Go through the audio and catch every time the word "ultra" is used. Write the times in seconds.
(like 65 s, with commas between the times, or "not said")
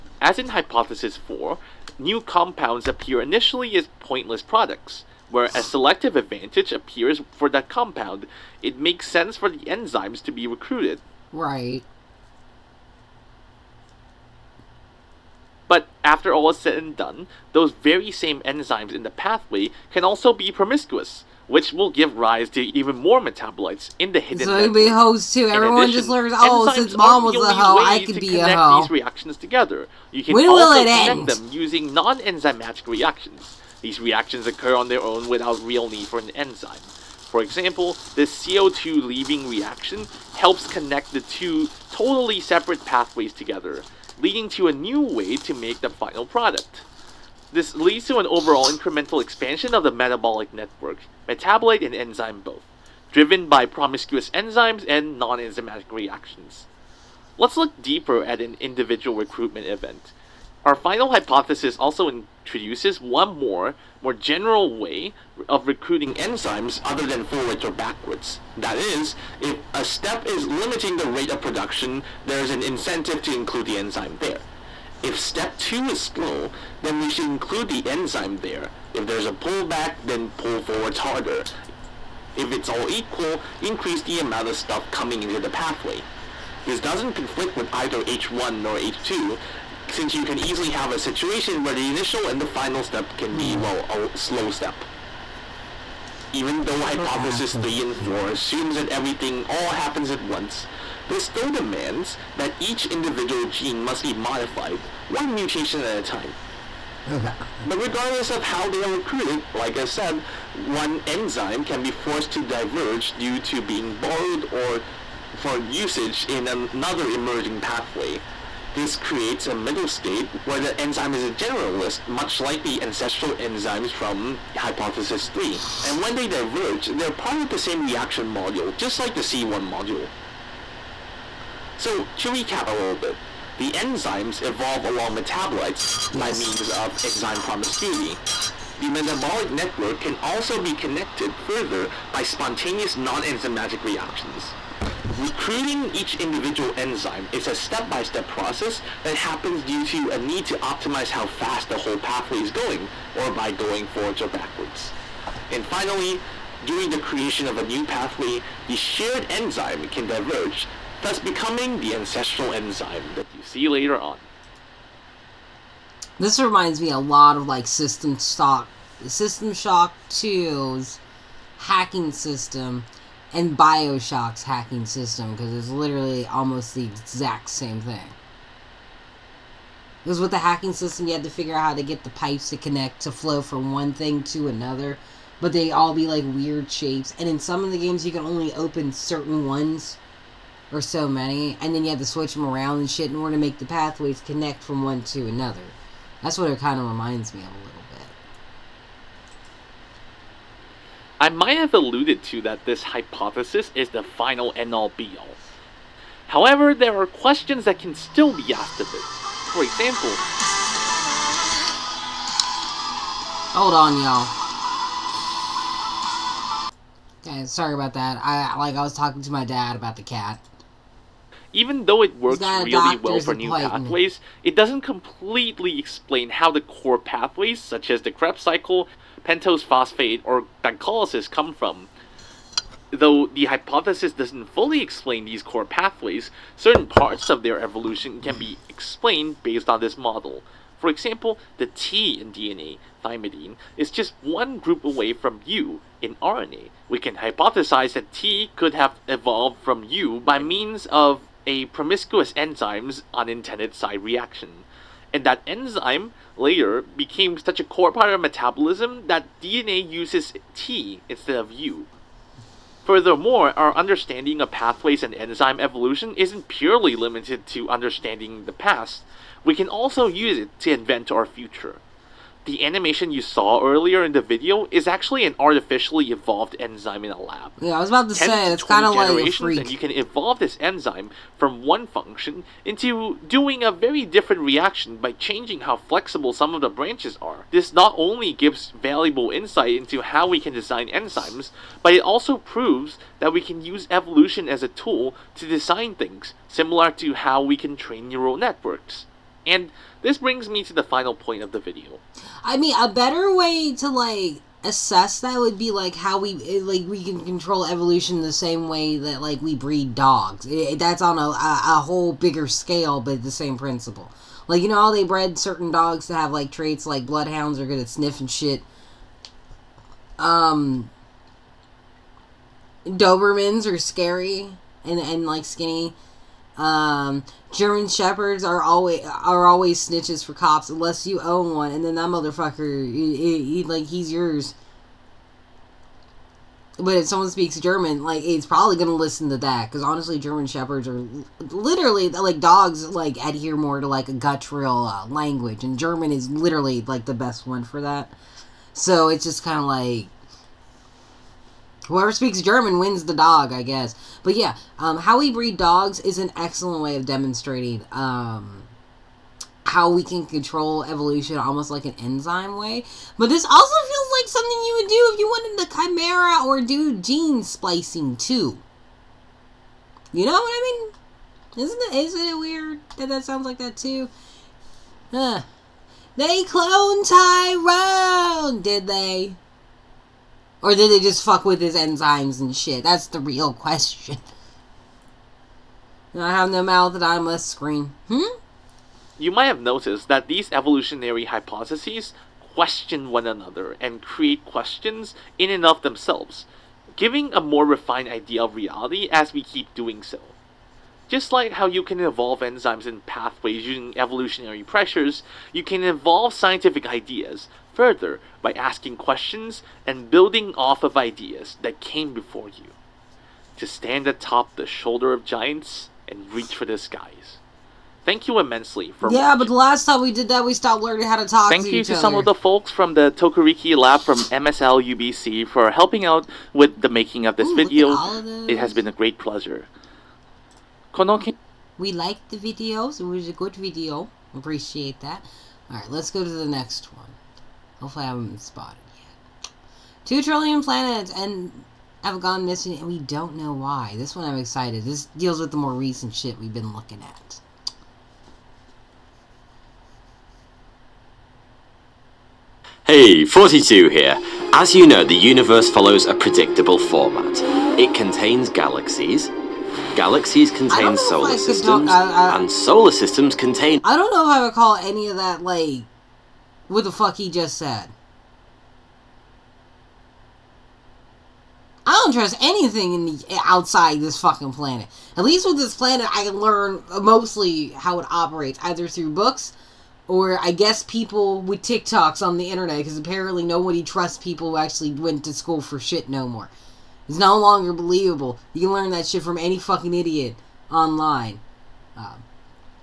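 not said.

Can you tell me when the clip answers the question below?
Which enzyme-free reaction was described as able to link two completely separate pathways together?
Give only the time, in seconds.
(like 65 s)
38 s.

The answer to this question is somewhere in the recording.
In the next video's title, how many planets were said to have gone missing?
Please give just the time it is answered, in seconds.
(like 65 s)
440 s.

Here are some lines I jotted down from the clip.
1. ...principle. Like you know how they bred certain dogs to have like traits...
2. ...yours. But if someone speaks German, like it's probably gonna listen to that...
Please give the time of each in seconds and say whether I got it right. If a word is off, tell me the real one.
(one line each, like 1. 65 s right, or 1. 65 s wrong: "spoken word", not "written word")
1. 313 s right
2. 334 s right.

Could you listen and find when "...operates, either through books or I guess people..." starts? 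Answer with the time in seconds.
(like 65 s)
478 s.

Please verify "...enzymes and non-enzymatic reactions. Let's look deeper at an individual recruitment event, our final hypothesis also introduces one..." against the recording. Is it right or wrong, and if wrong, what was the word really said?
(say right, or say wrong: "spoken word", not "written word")
right.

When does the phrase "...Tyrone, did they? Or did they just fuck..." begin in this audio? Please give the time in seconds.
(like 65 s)
377 s.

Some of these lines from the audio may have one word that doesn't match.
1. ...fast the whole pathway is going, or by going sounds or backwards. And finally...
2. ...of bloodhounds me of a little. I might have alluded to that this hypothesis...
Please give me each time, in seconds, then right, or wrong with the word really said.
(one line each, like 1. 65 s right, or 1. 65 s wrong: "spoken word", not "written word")
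1. 151 s wrong: "forwards", not "sounds"
2. 196 s wrong: "reminds", not "bloodhounds".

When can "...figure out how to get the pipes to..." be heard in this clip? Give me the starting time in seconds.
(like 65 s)
181 s.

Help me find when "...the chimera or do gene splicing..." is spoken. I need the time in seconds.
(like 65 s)
365 s.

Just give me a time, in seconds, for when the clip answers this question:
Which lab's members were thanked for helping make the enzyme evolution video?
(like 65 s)
423 s.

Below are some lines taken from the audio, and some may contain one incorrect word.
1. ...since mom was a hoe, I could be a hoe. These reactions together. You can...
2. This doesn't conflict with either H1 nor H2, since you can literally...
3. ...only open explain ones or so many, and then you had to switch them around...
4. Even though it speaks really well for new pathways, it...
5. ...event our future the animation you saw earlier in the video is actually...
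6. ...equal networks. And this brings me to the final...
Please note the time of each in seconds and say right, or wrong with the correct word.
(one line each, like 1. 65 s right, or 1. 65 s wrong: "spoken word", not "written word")
1. 26 s right
2. 86 s wrong: "easily", not "literally"
3. 188 s wrong: "certain", not "explain"
4. 221 s wrong: "works", not "speaks"
5. 270 s wrong: "invent", not "event"
6. 298 s wrong: "neural", not "equal".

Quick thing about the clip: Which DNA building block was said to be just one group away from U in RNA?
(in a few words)
thymidine.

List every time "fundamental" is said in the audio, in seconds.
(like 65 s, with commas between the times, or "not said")
not said.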